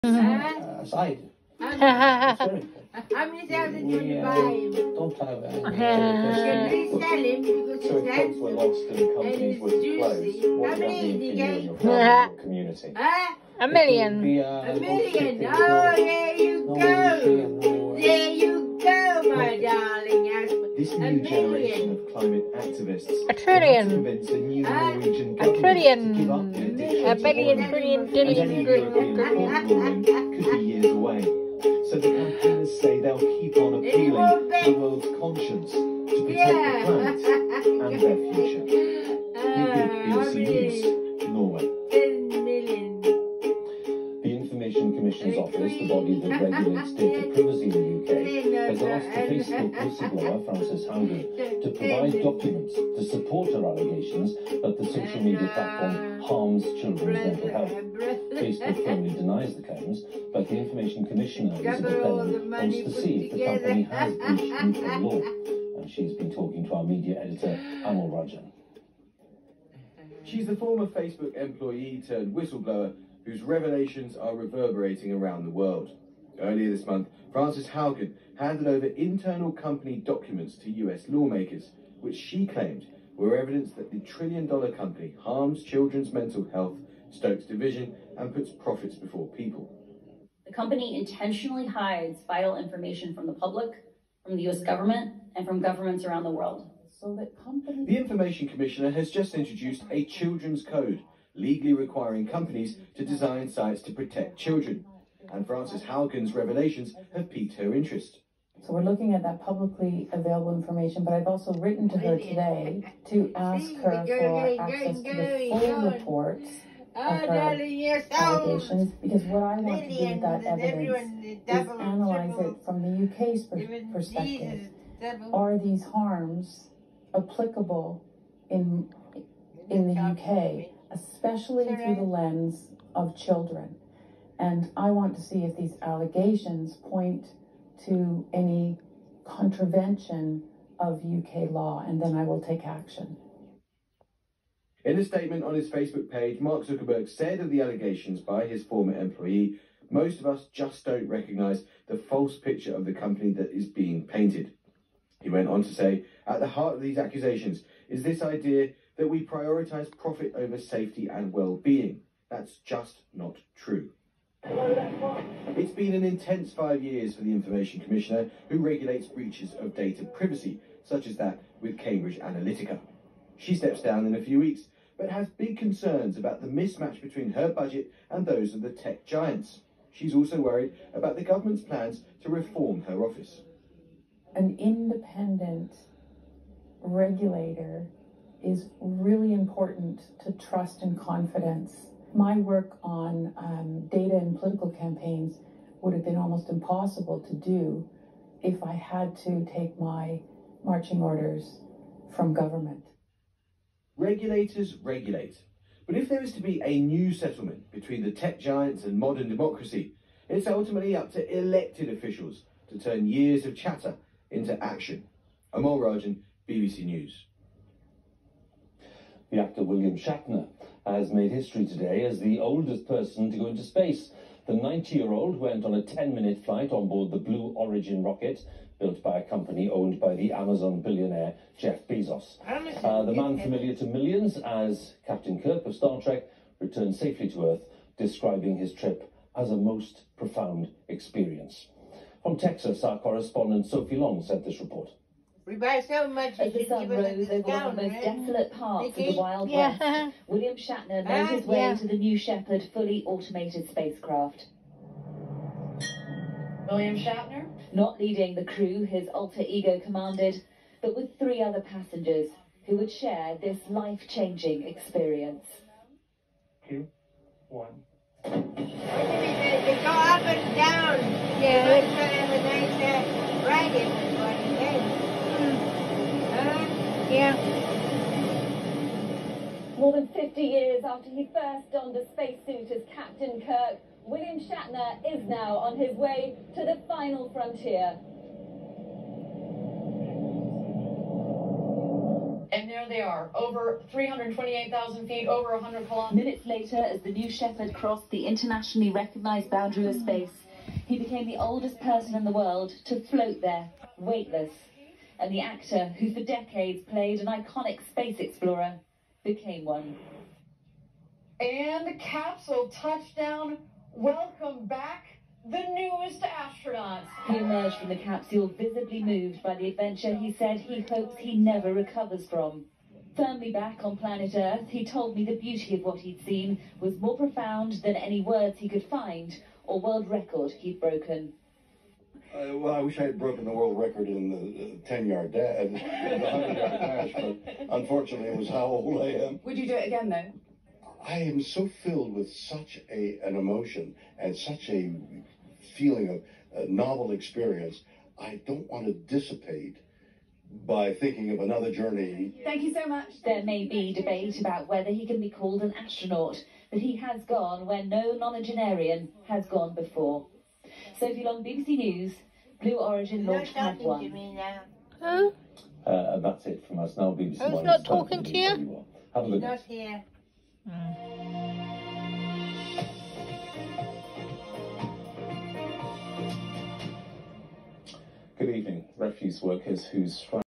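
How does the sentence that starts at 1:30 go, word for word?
The company intentionally hides vital information from the public, from the US government, and from governments around the world.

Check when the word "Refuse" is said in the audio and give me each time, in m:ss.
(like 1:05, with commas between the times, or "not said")
6:18.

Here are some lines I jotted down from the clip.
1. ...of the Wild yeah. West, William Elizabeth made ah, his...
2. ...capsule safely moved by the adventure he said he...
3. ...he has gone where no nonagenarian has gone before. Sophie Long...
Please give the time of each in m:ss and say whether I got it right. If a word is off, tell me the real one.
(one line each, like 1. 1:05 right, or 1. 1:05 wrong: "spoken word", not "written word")
1. 4:08 wrong: "Shatner", not "Elizabeth"
2. 5:17 wrong: "visibly", not "safely"
3. 5:56 right.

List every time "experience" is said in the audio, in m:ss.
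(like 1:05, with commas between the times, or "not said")
4:00, 4:24, 5:47.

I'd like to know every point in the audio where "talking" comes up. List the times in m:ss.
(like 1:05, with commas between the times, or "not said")
1:06, 6:07.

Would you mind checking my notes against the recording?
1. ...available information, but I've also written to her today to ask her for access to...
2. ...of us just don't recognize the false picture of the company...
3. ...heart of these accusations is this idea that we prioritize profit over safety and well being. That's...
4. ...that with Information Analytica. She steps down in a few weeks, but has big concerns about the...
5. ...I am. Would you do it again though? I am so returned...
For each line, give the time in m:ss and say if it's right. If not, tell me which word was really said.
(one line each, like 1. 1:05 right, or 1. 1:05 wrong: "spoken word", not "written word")
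1. 1:50 right
2. 2:30 right
3. 2:36 right
4. 2:51 wrong: "Cambridge", not "Information"
5. 5:39 wrong: "filled", not "returned".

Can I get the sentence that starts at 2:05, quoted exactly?
Are these harms applicable in, in the UK, especially through the lens of children?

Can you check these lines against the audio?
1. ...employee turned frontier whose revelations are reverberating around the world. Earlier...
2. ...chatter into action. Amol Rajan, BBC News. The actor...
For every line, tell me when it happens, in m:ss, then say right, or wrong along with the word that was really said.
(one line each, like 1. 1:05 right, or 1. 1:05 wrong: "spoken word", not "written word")
1. 1:11 wrong: "whistleblower", not "frontier"
2. 3:33 right.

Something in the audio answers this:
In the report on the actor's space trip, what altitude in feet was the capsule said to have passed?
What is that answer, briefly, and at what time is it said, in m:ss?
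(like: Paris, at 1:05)
328,000 feet, at 4:53.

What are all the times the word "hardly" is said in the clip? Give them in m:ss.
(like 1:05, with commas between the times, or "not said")
not said.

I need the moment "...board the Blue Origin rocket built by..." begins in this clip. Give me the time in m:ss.
3:46.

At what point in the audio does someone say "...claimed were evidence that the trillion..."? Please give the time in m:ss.
1:22.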